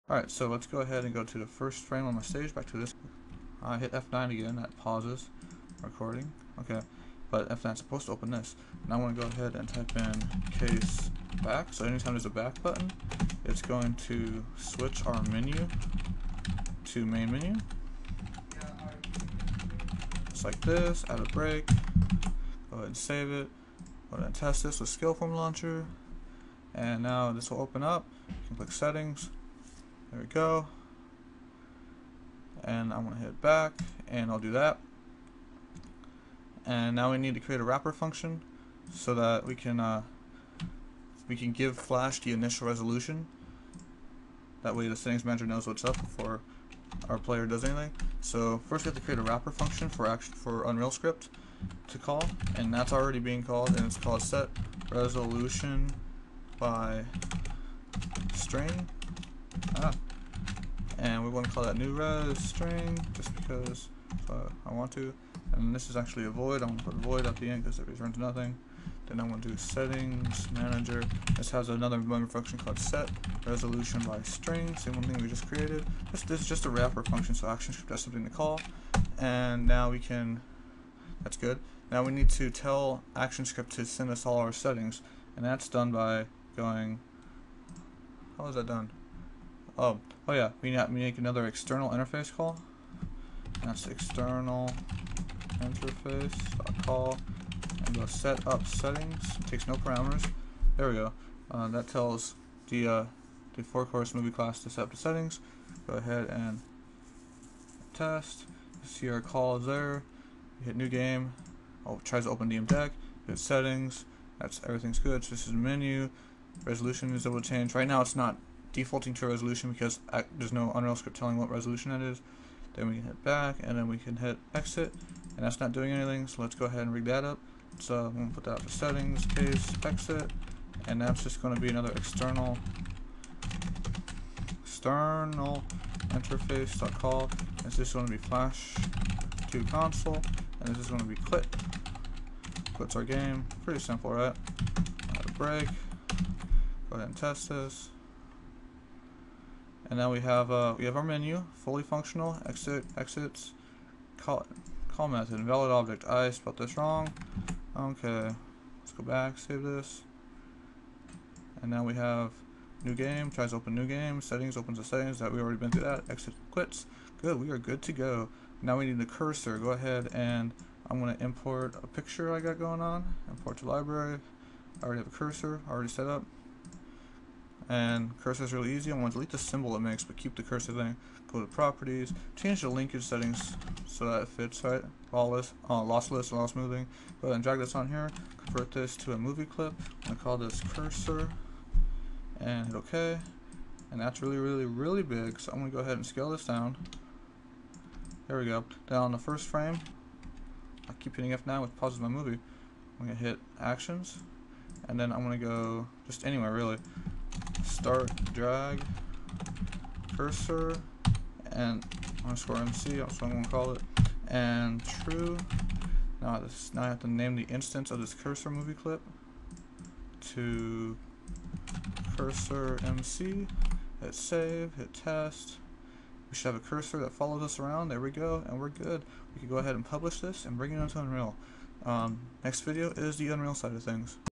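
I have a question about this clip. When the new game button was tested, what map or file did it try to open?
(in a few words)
DM deck.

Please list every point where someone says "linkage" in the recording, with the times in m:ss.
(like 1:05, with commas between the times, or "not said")
3:02.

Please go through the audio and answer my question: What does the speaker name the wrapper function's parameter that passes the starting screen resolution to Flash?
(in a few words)
new res string.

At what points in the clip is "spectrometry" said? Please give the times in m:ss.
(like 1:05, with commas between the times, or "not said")
not said.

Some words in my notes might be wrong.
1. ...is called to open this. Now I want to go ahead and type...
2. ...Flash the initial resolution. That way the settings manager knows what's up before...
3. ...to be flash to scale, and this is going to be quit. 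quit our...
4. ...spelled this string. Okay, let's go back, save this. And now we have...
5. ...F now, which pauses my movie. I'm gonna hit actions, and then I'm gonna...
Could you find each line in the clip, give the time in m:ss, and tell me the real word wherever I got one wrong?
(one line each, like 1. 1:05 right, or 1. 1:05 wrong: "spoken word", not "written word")
1. 0:07 wrong: "supposed", not "called"
2. 0:41 right
3. 2:18 wrong: "console", not "scale"
4. 2:36 wrong: "wrong", not "string"
5. 3:21 right.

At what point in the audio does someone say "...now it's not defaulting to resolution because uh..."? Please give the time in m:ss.
1:57.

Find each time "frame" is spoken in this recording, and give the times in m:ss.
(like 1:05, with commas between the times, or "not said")
0:01, 3:19.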